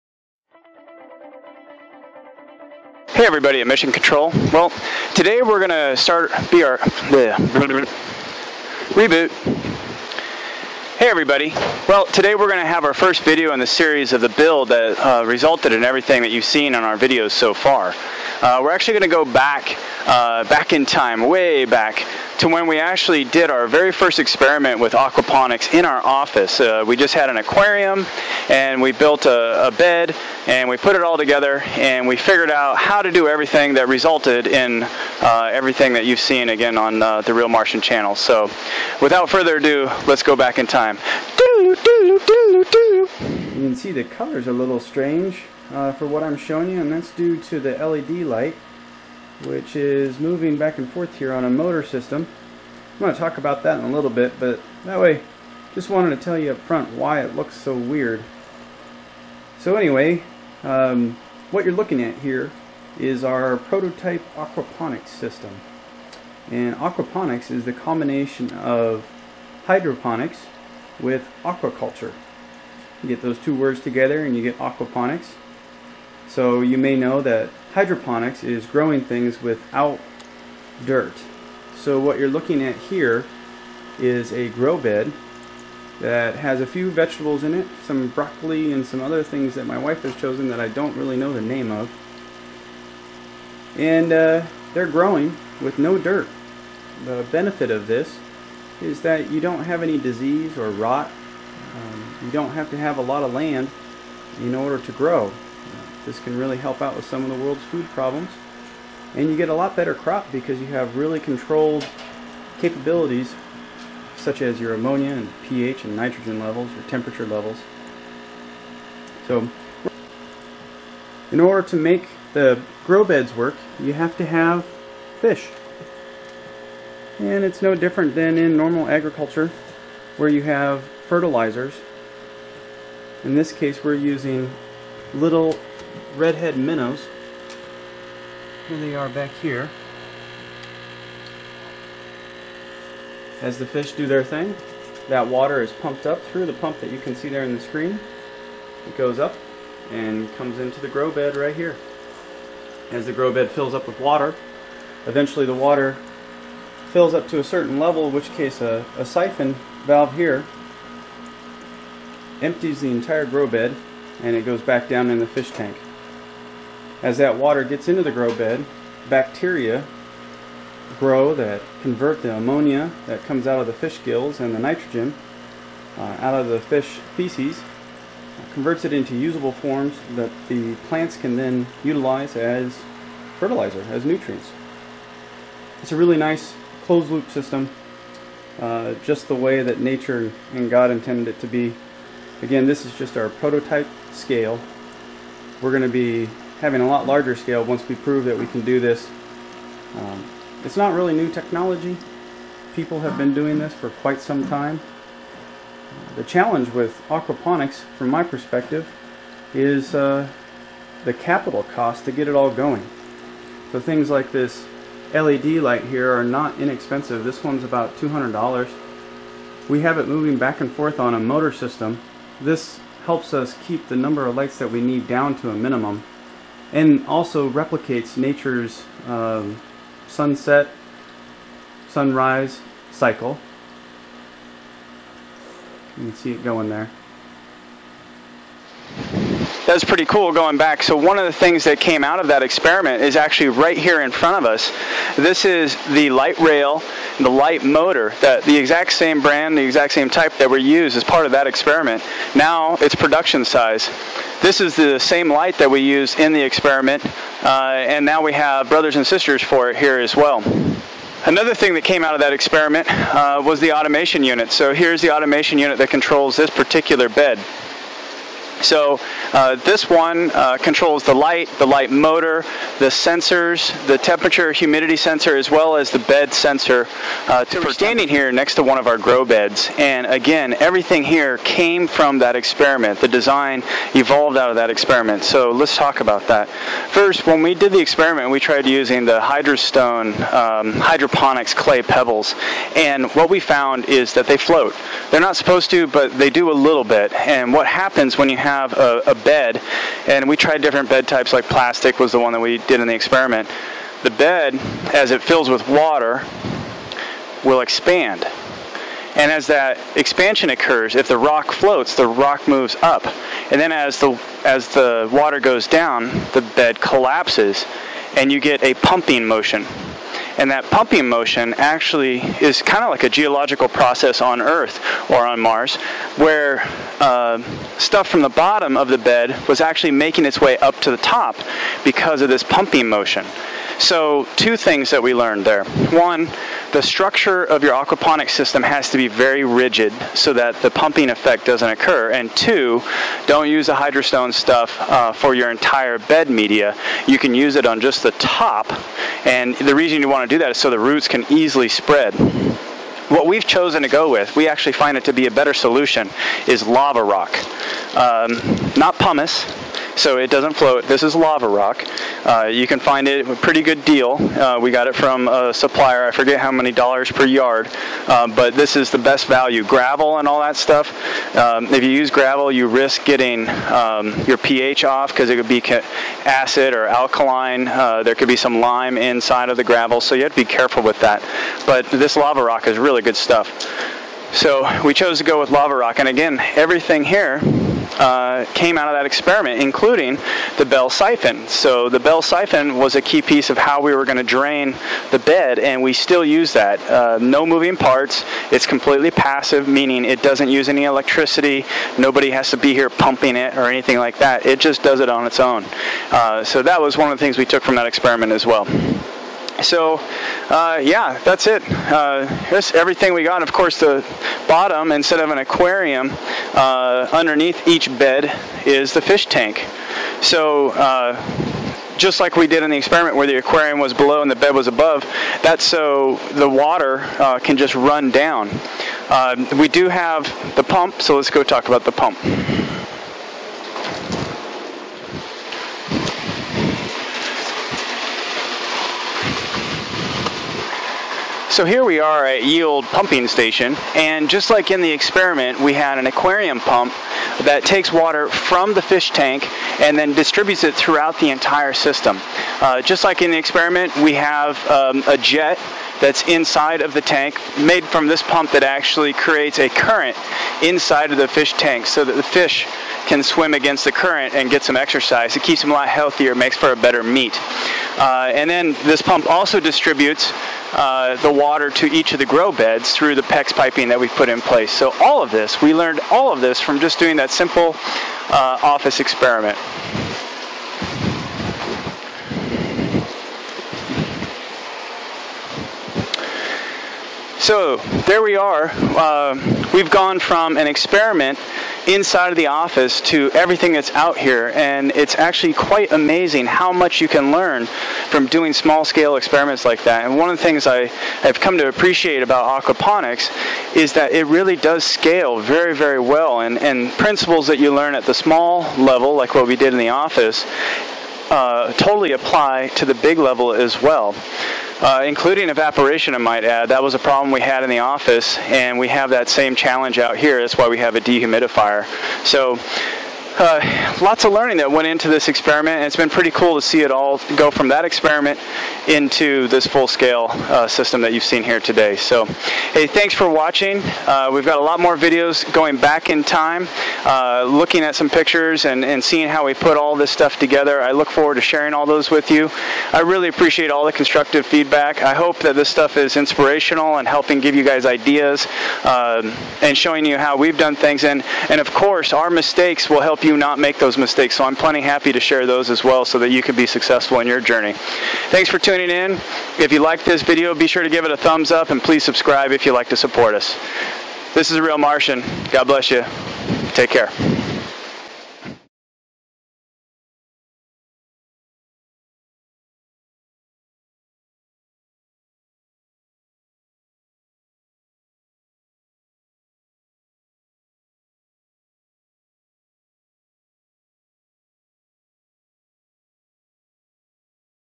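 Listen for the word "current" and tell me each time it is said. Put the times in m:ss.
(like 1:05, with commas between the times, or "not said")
7:39, 7:43.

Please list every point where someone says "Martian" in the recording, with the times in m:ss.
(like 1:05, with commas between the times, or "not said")
0:37, 9:24.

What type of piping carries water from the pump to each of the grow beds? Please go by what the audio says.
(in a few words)
PEX piping.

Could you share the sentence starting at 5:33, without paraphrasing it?
So, two things that we learned there.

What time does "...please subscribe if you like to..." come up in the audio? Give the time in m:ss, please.
9:21.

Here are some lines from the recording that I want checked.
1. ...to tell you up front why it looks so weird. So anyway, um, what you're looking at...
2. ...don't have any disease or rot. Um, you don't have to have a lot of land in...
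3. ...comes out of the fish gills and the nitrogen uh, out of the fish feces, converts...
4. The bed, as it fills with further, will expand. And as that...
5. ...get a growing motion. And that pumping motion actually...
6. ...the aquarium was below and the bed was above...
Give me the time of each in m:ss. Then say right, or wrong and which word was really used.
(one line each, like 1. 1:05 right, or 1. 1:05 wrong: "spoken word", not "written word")
1. 0:56 right
2. 1:39 right
3. 2:53 right
4. 5:04 wrong: "water", not "further"
5. 5:18 wrong: "pumping", not "growing"
6. 7:03 right.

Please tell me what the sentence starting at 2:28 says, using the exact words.
It goes up and comes into the grow bed right here.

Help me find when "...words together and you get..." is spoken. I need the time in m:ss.
1:13.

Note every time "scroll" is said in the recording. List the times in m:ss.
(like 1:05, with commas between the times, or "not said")
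not said.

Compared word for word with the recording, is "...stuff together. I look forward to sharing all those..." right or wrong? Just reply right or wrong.
right.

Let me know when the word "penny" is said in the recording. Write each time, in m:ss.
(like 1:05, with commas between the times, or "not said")
not said.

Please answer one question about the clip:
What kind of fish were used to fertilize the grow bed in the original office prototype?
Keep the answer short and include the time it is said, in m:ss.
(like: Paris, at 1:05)
redhead minnows, at 2:16.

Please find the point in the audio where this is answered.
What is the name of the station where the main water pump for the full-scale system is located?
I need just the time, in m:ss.
7:22.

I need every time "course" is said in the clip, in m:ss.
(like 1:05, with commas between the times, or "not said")
6:53, 9:11.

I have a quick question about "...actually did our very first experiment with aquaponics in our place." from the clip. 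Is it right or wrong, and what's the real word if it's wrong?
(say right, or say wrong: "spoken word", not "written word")
wrong: "office", not "place".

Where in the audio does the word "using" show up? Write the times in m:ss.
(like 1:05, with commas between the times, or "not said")
2:13, 4:48.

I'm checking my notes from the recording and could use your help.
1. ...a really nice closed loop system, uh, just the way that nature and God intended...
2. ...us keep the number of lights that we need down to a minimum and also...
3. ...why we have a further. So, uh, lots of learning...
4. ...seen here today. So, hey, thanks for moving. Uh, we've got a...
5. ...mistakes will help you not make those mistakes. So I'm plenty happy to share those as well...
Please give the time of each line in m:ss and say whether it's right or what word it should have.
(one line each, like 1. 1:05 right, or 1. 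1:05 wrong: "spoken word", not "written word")
1. 3:05 right
2. 3:43 right
3. 8:40 wrong: "dehumidifier", not "further"
4. 8:51 wrong: "watching", not "moving"
5. 9:12 right.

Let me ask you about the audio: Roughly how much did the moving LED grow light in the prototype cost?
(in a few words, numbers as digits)
$200.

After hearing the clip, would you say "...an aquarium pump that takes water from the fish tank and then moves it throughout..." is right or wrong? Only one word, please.
wrong.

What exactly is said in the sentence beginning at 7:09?
Uh, we do have the pump, so let's go talk about the pump.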